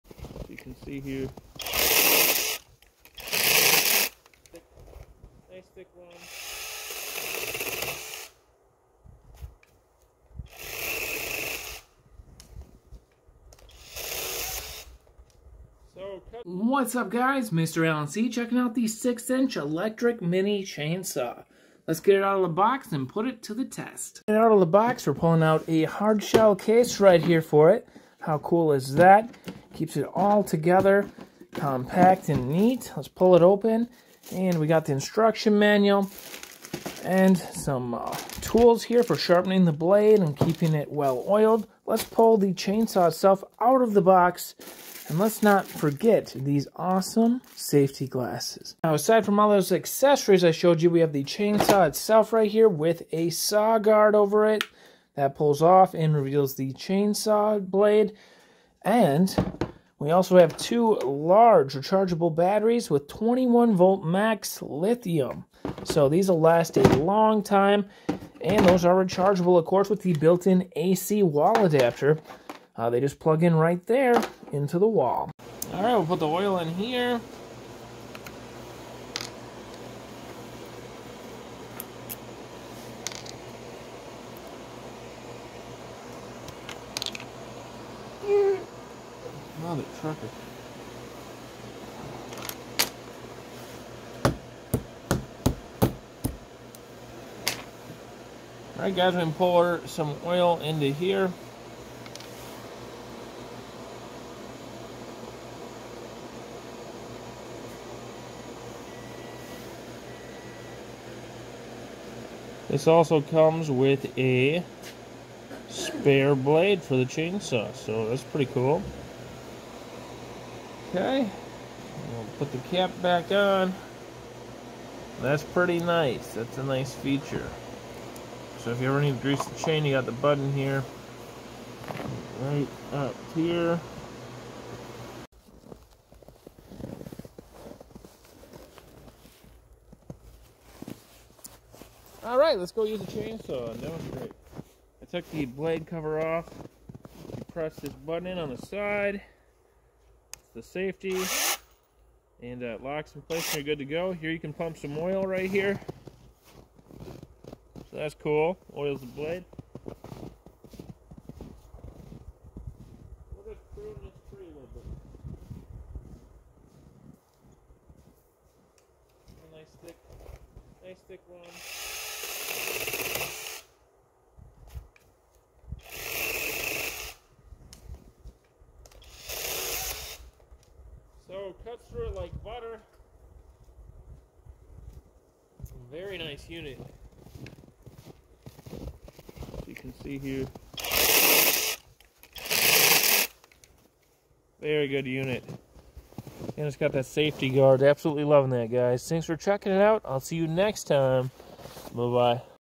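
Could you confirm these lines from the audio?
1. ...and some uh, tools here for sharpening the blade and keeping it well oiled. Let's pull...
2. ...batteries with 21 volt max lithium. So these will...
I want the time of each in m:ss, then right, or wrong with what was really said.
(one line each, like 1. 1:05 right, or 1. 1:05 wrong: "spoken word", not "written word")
1. 0:37 right
2. 1:02 right.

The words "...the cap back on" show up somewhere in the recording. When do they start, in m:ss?
2:02.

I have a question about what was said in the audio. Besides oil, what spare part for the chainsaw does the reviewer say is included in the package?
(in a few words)
spare blade.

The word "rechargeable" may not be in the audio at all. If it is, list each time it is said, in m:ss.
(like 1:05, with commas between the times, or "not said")
1:01, 1:08.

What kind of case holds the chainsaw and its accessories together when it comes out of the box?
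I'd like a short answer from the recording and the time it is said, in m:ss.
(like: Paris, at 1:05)
hard shell case, at 0:25.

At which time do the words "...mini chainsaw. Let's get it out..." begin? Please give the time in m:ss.
0:20.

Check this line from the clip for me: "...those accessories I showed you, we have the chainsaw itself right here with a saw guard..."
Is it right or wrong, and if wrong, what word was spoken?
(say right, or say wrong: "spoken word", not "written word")
right.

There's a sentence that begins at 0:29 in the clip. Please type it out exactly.
Keeps it all together, compact and neat.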